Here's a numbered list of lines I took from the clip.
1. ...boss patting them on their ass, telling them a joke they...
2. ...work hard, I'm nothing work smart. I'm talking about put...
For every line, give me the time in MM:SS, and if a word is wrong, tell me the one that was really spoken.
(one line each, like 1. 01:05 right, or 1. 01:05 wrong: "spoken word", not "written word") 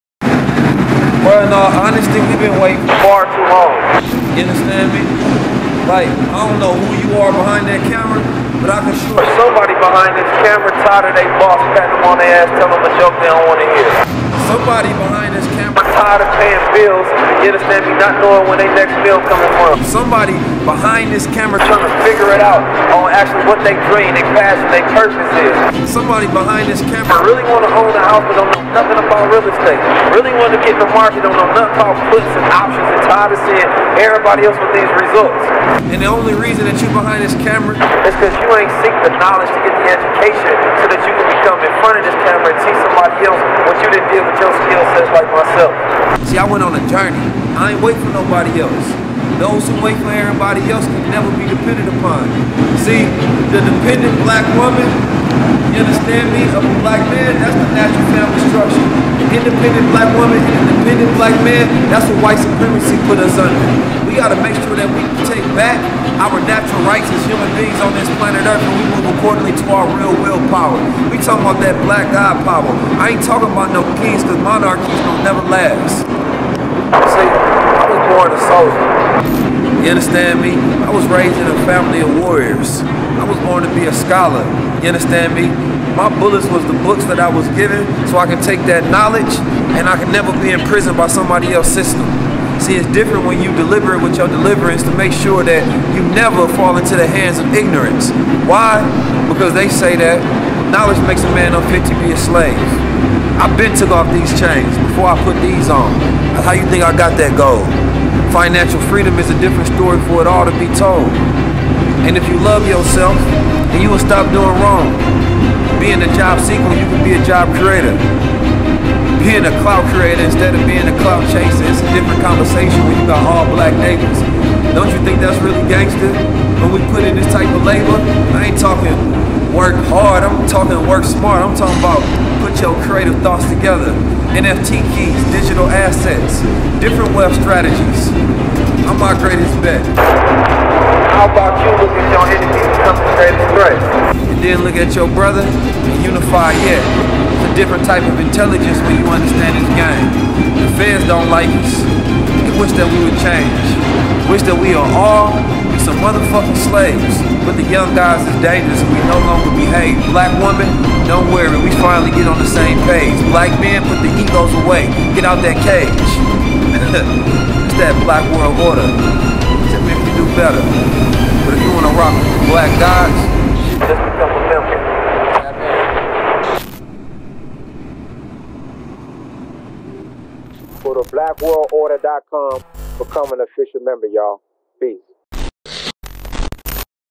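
1. 00:11 right
2. 02:09 wrong: "talking", not "nothing".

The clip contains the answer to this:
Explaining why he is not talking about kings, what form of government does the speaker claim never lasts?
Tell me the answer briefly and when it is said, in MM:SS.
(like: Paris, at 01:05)
Monarchies, at 01:14.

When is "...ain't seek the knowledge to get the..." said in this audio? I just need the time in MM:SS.
00:38.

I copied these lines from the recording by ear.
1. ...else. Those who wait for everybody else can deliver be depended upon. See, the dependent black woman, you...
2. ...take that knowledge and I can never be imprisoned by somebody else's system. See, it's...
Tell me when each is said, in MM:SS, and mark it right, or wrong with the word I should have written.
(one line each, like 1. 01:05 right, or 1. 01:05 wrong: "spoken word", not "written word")
1. 00:48 wrong: "never", not "deliver"
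2. 01:28 right.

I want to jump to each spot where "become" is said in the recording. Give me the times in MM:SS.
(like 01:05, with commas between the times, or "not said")
02:22, 02:54, 03:02.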